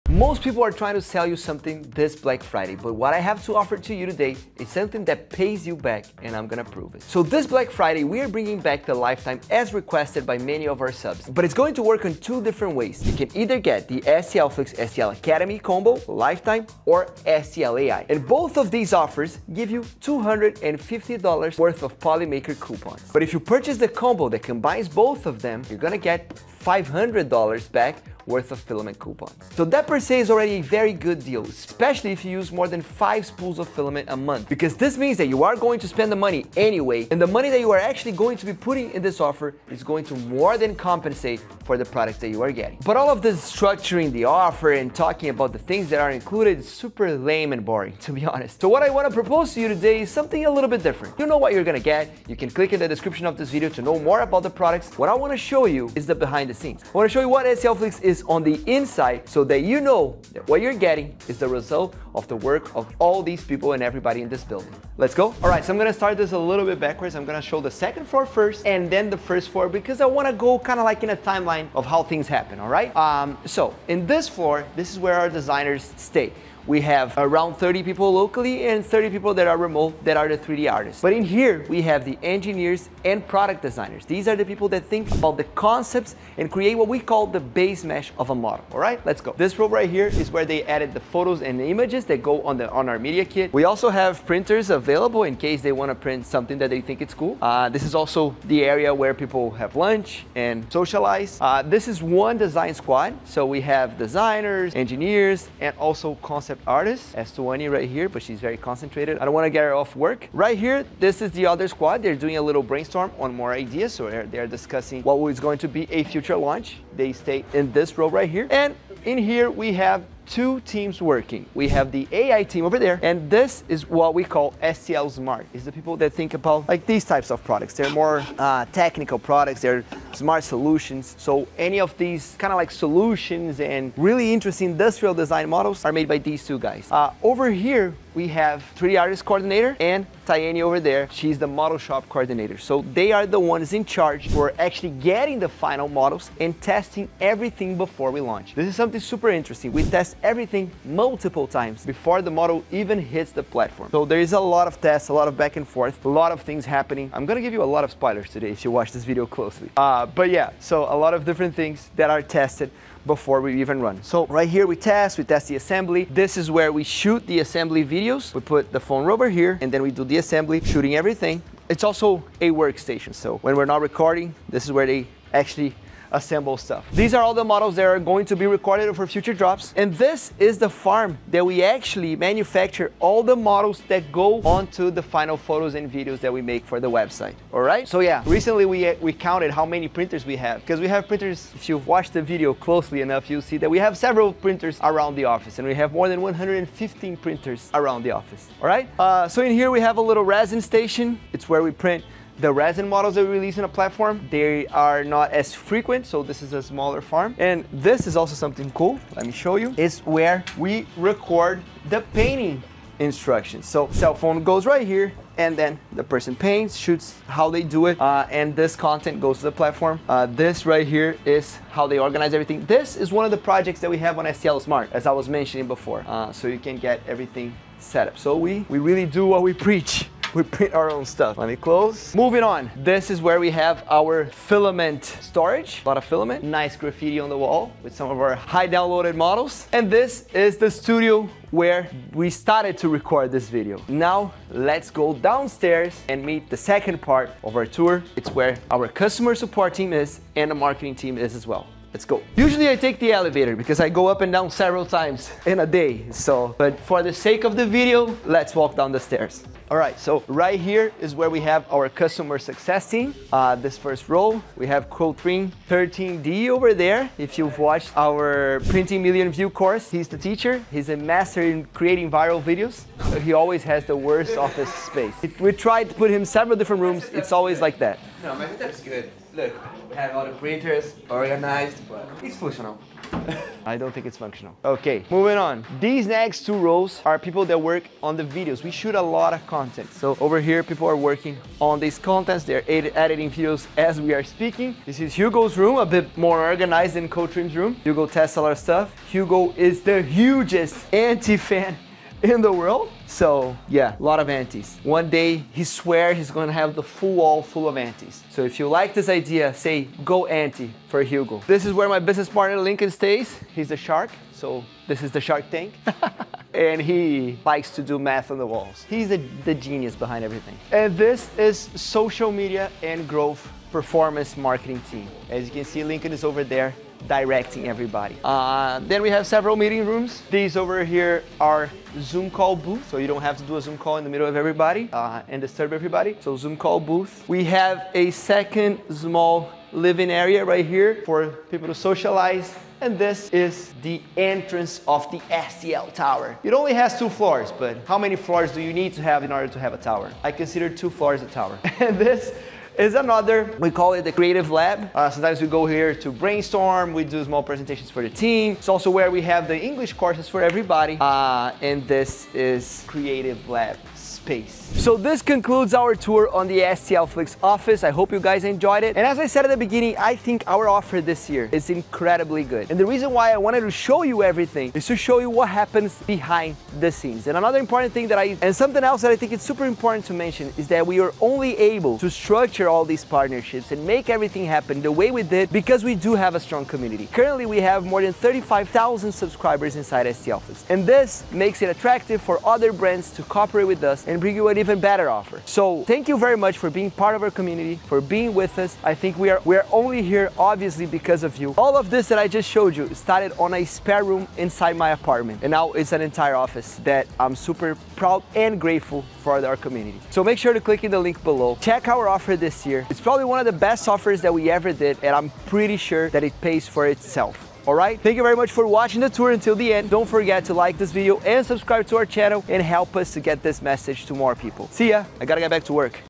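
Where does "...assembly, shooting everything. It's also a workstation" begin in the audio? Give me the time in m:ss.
2:50.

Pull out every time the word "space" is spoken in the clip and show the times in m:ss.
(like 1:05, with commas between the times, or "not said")
4:34, 6:04.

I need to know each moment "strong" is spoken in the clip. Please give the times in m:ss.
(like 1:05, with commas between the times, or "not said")
6:26.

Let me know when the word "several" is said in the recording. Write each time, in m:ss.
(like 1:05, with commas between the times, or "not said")
3:13, 4:14, 4:36, 5:29.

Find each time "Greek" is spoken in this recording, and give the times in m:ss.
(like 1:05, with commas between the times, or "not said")
not said.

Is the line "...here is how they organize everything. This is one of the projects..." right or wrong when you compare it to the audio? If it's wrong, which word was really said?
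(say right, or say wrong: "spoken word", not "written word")
right.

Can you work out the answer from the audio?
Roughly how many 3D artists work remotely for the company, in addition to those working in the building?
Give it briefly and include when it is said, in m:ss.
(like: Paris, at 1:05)
30, at 1:18.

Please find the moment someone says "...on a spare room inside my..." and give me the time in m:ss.
6:43.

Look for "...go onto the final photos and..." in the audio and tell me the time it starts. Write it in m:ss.
3:04.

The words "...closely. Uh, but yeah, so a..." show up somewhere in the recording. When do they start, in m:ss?
2:39.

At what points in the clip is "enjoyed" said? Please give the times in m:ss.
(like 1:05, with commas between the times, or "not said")
6:08.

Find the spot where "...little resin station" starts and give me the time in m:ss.
3:20.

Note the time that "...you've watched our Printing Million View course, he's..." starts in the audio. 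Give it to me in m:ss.
4:27.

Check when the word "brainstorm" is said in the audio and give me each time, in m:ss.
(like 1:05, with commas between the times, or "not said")
1:52, 5:56.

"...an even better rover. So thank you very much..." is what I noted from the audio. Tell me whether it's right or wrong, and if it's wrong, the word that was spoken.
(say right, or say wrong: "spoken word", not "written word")
wrong: "offer", not "rover".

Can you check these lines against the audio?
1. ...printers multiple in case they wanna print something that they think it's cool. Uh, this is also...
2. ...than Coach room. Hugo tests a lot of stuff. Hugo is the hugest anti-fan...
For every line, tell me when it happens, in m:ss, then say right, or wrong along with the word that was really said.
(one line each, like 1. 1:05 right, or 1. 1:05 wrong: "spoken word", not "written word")
1. 1:34 wrong: "available", not "multiple"
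2. 4:56 right.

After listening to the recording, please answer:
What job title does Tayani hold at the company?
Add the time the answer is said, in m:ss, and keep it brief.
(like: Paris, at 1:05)
Model shop coordinator, at 2:21.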